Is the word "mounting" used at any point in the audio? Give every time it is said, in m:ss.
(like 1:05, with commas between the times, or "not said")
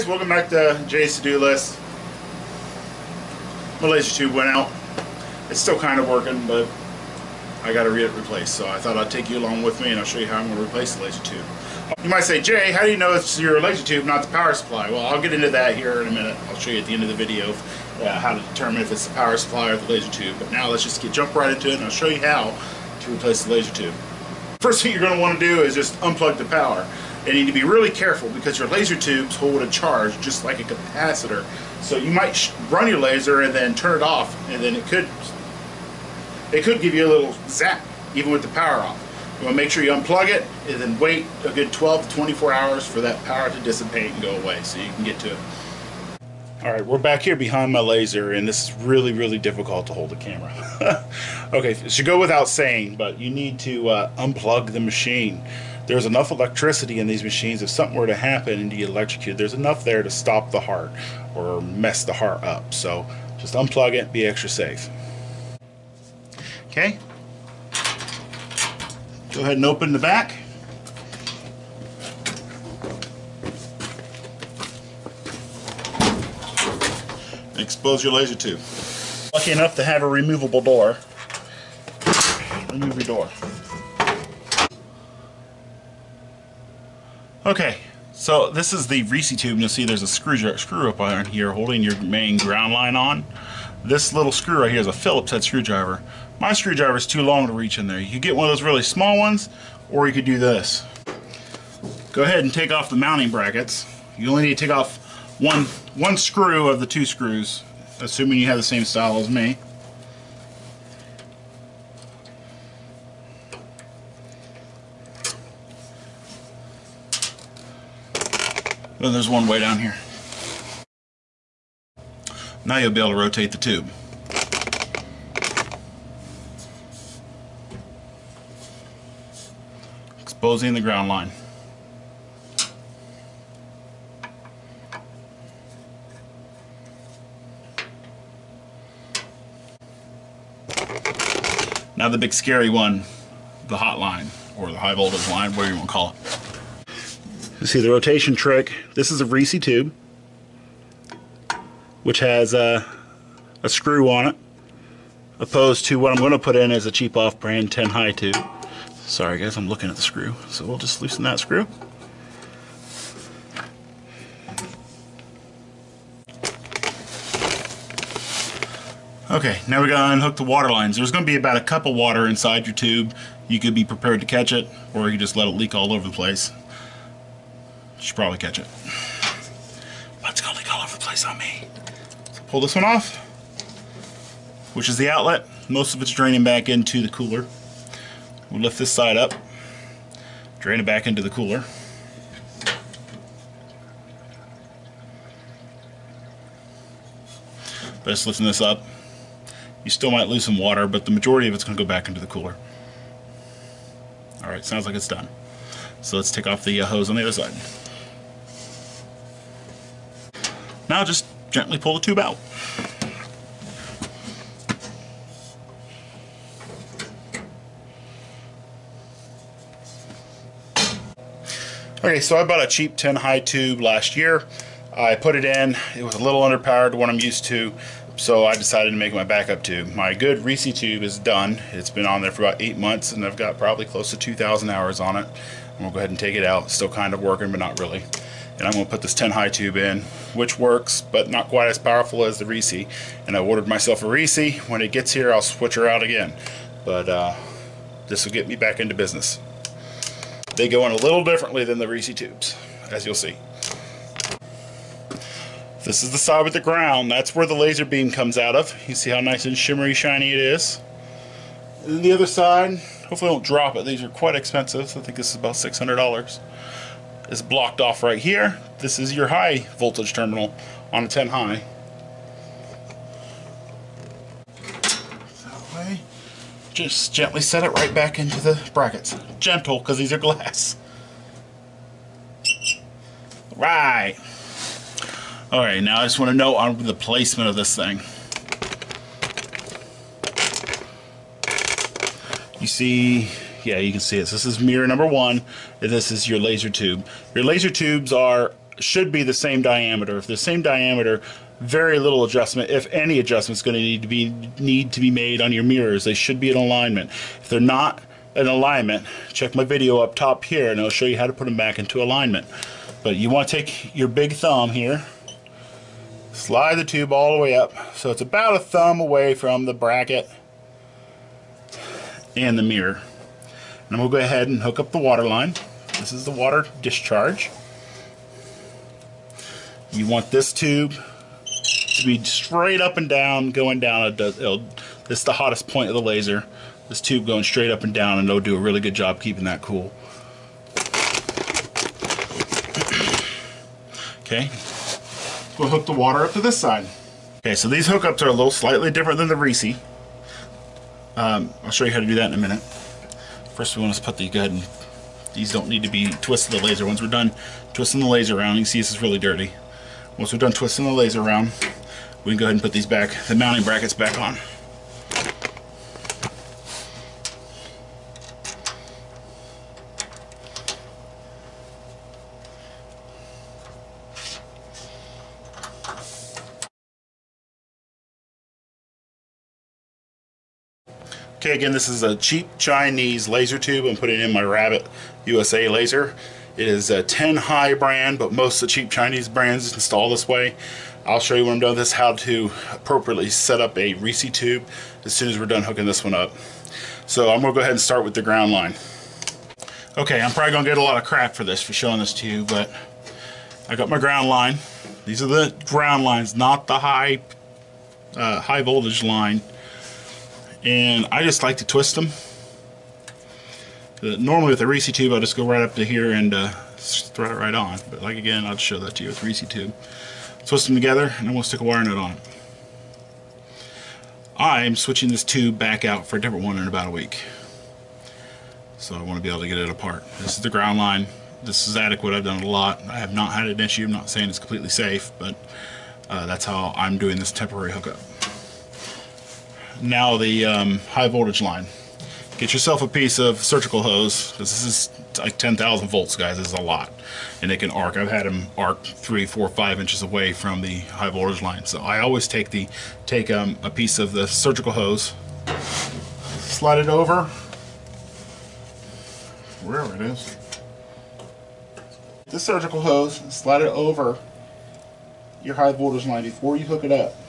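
1:42, 6:03.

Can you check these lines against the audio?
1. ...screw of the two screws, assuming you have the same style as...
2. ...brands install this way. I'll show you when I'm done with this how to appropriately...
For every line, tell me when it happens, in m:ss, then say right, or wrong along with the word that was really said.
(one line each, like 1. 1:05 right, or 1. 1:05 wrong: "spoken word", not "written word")
1. 1:46 right
2. 6:29 right.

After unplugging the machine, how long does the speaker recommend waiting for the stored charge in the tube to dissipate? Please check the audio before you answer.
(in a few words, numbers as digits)
12 to 24 hours.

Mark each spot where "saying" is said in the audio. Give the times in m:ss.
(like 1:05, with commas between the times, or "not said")
0:52, 7:14.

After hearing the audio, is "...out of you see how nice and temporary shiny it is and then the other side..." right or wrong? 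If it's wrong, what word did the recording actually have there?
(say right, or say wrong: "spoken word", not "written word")
wrong: "shimmery", not "temporary".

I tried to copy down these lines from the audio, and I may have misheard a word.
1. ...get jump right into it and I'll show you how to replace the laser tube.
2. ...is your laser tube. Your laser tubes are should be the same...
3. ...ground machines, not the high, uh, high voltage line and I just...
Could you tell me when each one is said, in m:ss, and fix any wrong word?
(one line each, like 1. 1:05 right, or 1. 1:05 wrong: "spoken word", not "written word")
1. 0:20 right
2. 4:56 right
3. 6:45 wrong: "lines", not "machines".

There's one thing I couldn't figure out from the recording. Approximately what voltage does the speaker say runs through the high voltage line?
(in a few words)
10,000 volts.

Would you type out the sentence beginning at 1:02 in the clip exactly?
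So just unplug it, be extra safe.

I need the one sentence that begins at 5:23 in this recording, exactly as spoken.
And we'll go ahead and hook up the water line.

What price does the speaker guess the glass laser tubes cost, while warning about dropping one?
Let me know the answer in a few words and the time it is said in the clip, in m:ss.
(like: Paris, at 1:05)
$600, at 4:25.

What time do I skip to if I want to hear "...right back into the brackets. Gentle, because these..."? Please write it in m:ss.
4:37.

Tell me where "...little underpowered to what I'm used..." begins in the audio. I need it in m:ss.
3:46.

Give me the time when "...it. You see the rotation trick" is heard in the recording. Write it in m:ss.
2:26.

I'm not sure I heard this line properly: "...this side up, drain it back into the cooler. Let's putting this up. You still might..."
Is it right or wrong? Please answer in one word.
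wrong.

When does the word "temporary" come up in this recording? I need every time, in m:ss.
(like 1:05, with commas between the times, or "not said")
7:17.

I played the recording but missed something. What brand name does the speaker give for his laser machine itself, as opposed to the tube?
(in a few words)
Rabbit USA.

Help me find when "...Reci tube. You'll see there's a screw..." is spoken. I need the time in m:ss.
1:29.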